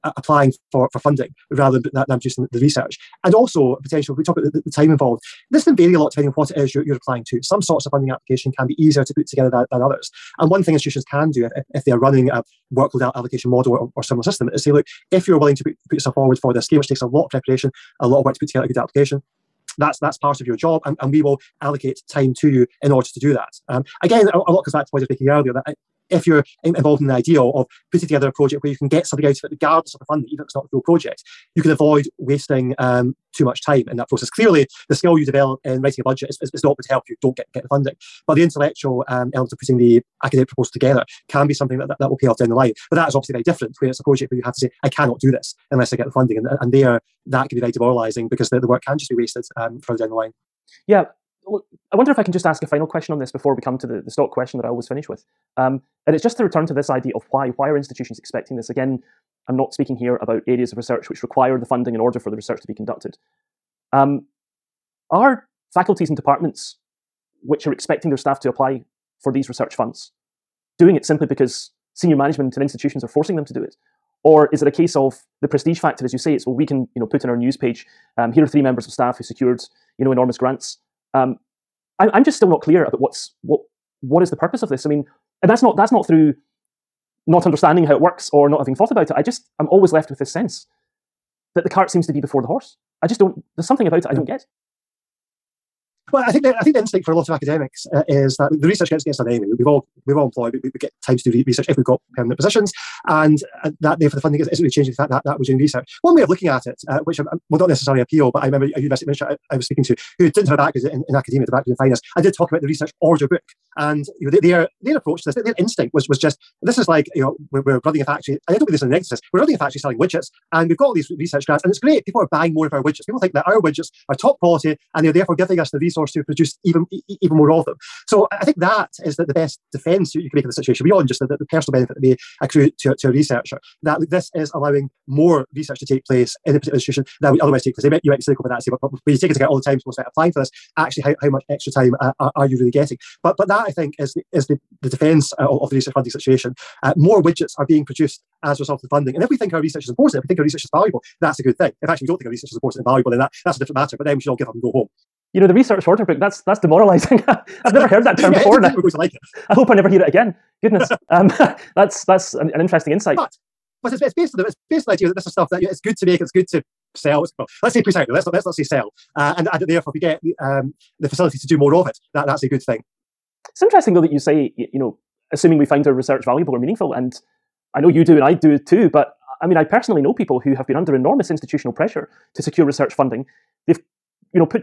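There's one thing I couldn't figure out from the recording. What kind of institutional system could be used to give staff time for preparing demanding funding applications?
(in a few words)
workload allocation model.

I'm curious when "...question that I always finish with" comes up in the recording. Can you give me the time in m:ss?
0:54.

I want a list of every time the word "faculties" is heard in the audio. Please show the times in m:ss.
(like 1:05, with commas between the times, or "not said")
1:05.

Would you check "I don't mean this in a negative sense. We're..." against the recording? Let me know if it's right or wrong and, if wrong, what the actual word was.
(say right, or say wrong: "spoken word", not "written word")
right.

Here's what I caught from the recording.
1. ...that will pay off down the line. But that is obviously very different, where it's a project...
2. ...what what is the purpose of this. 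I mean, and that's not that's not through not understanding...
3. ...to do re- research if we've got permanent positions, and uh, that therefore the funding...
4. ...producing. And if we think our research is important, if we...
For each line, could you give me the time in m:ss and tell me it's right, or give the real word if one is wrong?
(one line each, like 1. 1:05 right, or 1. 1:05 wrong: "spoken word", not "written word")
1. 0:41 right
2. 1:23 right
3. 1:41 right
4. 2:28 wrong: "funding", not "producing".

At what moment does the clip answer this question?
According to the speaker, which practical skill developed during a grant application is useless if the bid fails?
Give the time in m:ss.
0:35.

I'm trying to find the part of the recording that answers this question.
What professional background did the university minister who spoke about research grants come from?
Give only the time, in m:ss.
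1:51.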